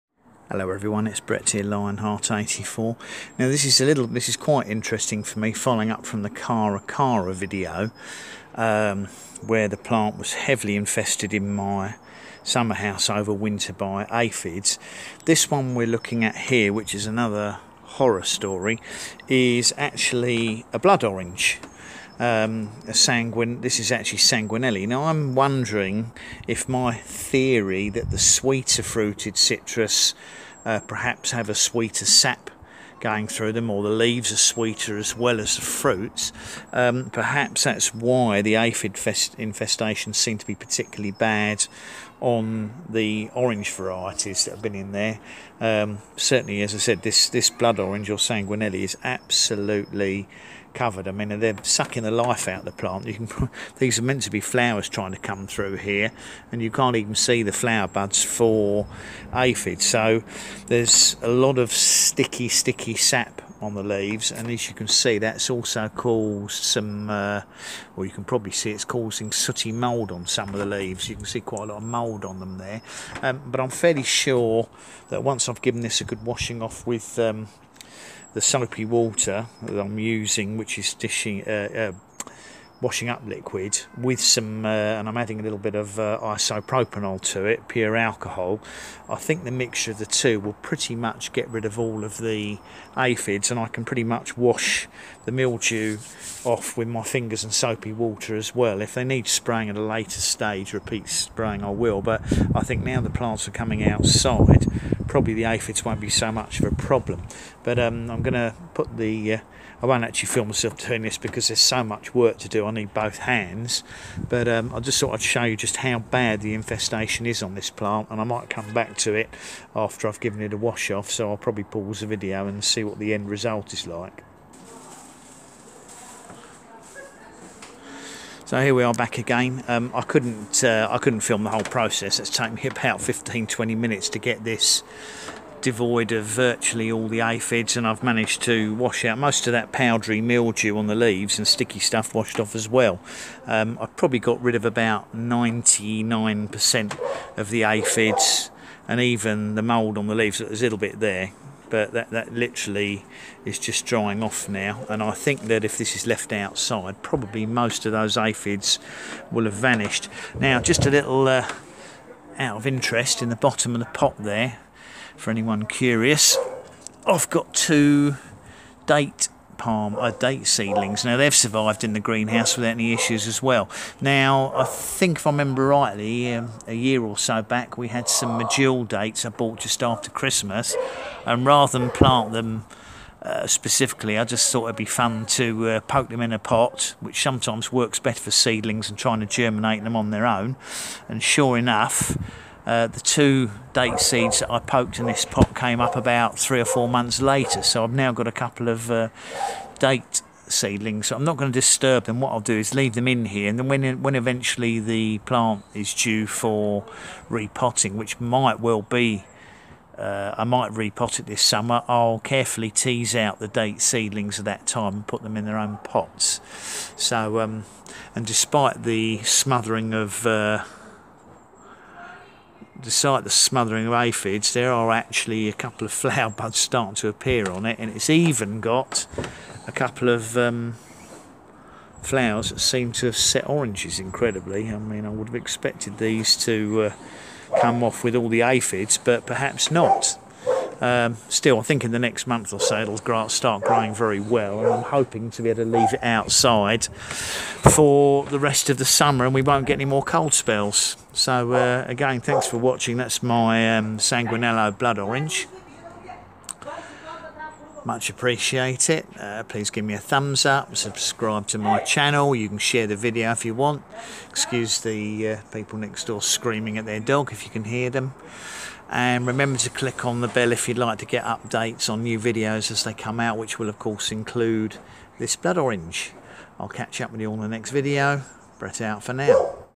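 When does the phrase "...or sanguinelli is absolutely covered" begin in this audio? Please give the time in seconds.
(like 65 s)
48 s.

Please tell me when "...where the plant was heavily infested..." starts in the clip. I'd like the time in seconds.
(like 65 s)
9 s.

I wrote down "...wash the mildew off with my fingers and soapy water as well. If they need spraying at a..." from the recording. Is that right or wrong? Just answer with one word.
right.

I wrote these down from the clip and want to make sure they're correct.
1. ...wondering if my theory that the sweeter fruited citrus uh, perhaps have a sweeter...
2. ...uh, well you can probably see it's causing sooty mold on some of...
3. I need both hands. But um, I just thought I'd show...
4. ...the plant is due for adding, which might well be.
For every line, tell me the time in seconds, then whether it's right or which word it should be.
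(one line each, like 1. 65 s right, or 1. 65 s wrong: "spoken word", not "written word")
1. 25 s right
2. 67 s right
3. 112 s right
4. 204 s wrong: "repotting", not "adding".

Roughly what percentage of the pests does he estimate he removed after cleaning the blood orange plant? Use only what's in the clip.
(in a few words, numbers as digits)
99%.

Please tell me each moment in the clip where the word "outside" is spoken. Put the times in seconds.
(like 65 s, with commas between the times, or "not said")
103 s, 156 s, 246 s.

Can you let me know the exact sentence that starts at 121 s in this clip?
So I'll probably pause the video and see what the end result is like.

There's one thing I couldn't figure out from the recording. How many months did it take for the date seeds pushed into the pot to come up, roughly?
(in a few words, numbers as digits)
3 or 4 months.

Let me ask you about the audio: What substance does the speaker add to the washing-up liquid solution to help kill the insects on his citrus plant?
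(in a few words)
isopropanol.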